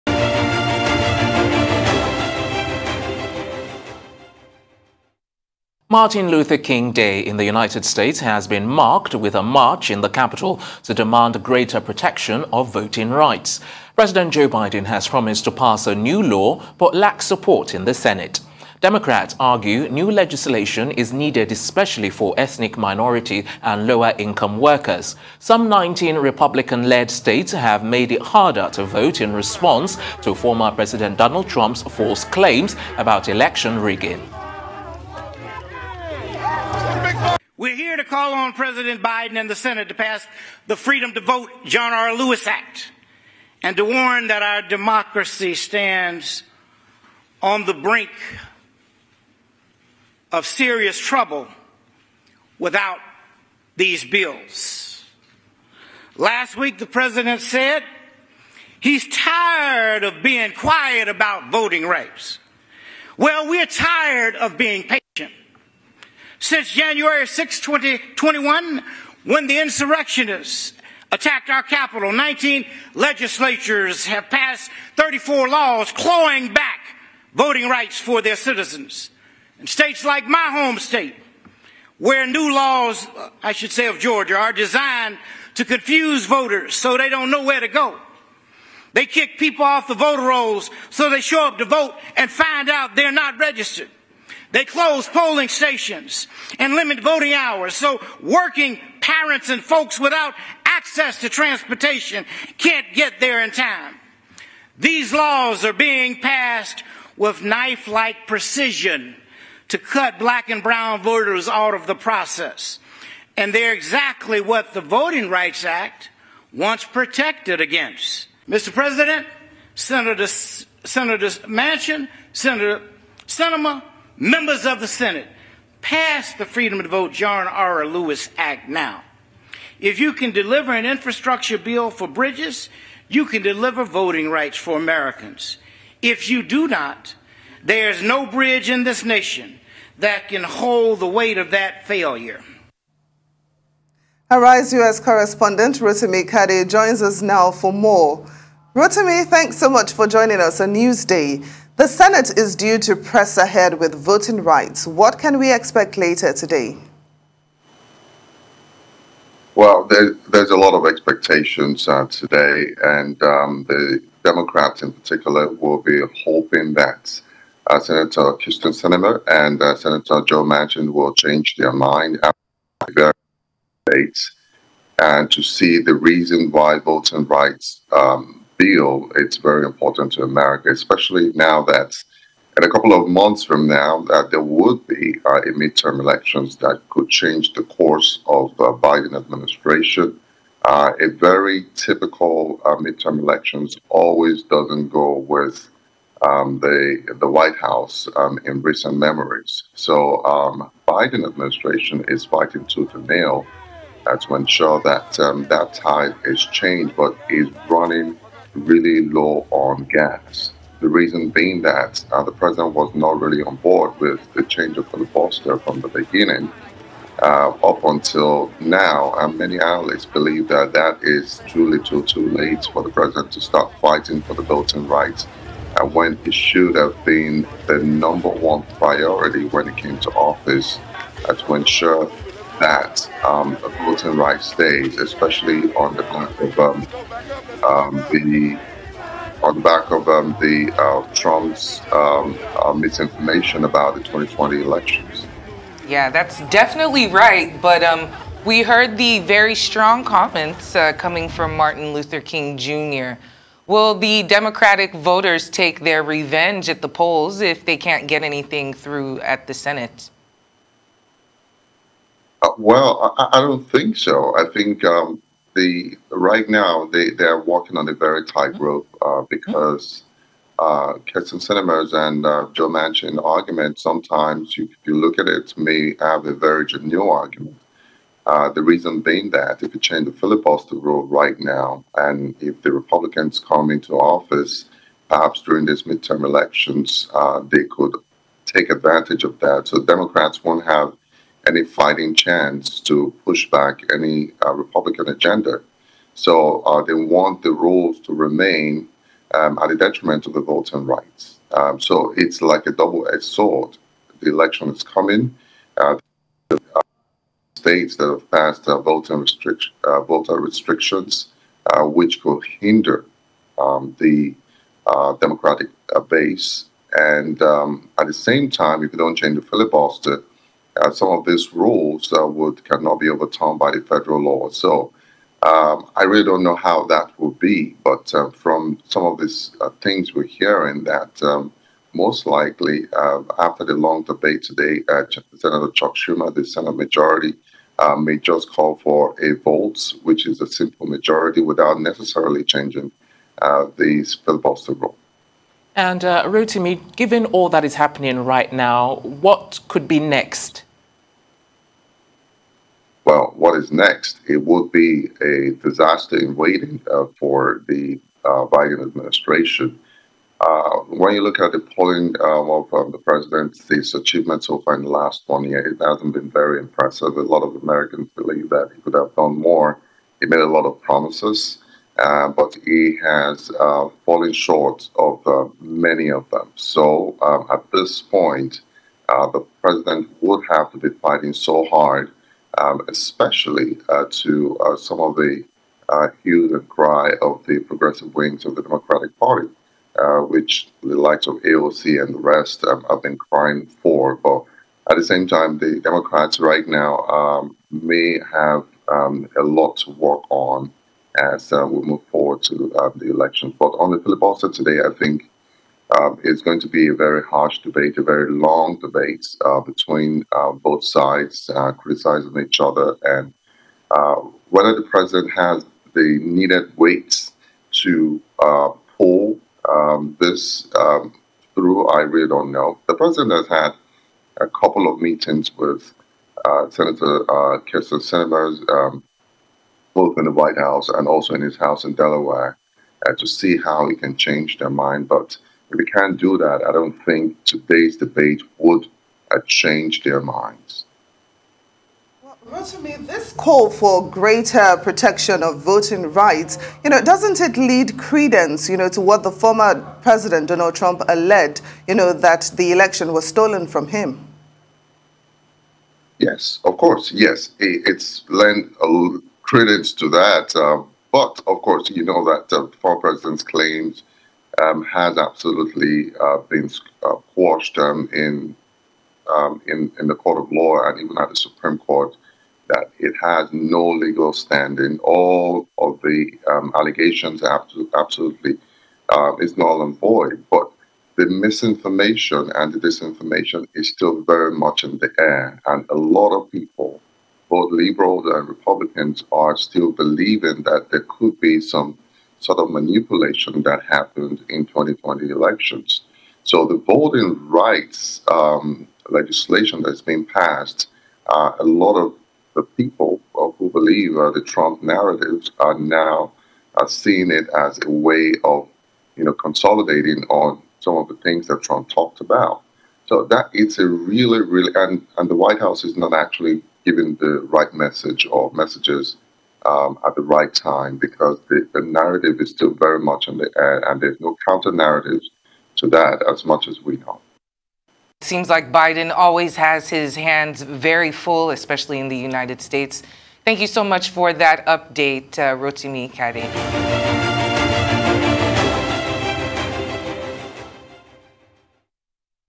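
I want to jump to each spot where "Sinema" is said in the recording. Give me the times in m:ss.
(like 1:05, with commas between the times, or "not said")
2:03, 2:48, 4:31, 7:08.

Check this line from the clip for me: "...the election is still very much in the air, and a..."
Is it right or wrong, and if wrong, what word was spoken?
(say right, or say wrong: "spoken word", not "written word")
wrong: "disinformation", not "election".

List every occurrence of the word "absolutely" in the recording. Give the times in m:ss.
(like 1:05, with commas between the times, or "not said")
7:45, 7:57.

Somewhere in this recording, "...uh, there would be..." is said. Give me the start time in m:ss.
3:04.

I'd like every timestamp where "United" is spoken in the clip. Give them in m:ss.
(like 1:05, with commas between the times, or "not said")
0:07, 8:52.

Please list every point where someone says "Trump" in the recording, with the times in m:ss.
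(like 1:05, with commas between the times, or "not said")
0:31, 4:01, 7:30, 8:24, 8:31.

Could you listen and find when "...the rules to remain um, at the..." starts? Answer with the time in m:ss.
4:57.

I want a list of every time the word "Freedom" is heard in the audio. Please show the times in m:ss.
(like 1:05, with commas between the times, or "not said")
0:40, 2:06.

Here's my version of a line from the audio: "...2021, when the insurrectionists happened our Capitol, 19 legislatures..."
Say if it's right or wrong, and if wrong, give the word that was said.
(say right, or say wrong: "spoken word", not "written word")
wrong: "attacked", not "happened".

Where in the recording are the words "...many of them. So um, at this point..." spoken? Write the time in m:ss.
6:15.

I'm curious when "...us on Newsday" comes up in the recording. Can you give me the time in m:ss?
2:30.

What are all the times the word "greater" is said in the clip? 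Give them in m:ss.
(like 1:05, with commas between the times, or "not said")
0:11, 7:24.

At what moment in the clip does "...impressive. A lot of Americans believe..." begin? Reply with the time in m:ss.
6:06.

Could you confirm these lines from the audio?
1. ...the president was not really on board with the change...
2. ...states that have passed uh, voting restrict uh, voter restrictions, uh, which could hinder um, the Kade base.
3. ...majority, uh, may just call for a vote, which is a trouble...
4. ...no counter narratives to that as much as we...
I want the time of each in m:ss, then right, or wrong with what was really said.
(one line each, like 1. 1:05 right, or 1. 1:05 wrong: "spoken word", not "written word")
1. 3:32 right
2. 5:07 wrong: "Democratic", not "Kade"
3. 5:36 wrong: "simple", not "trouble"
4. 8:44 right.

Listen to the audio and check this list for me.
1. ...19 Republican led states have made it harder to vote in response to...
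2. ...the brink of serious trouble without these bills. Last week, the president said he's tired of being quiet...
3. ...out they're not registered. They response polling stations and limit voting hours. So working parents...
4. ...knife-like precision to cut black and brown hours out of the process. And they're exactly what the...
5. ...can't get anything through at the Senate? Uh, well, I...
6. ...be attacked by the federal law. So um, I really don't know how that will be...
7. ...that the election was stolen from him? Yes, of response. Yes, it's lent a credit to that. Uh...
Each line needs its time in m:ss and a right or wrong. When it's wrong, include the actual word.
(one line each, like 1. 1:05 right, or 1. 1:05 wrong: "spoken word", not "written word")
1. 0:25 right
2. 0:47 right
3. 1:32 wrong: "close", not "response"
4. 1:47 wrong: "voters", not "hours"
5. 4:17 right
6. 5:22 wrong: "overturned", not "attacked"
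7. 7:32 wrong: "course", not "response".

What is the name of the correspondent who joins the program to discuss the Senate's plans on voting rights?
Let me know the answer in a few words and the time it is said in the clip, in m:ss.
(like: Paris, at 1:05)
Rotimi Kade, at 2:25.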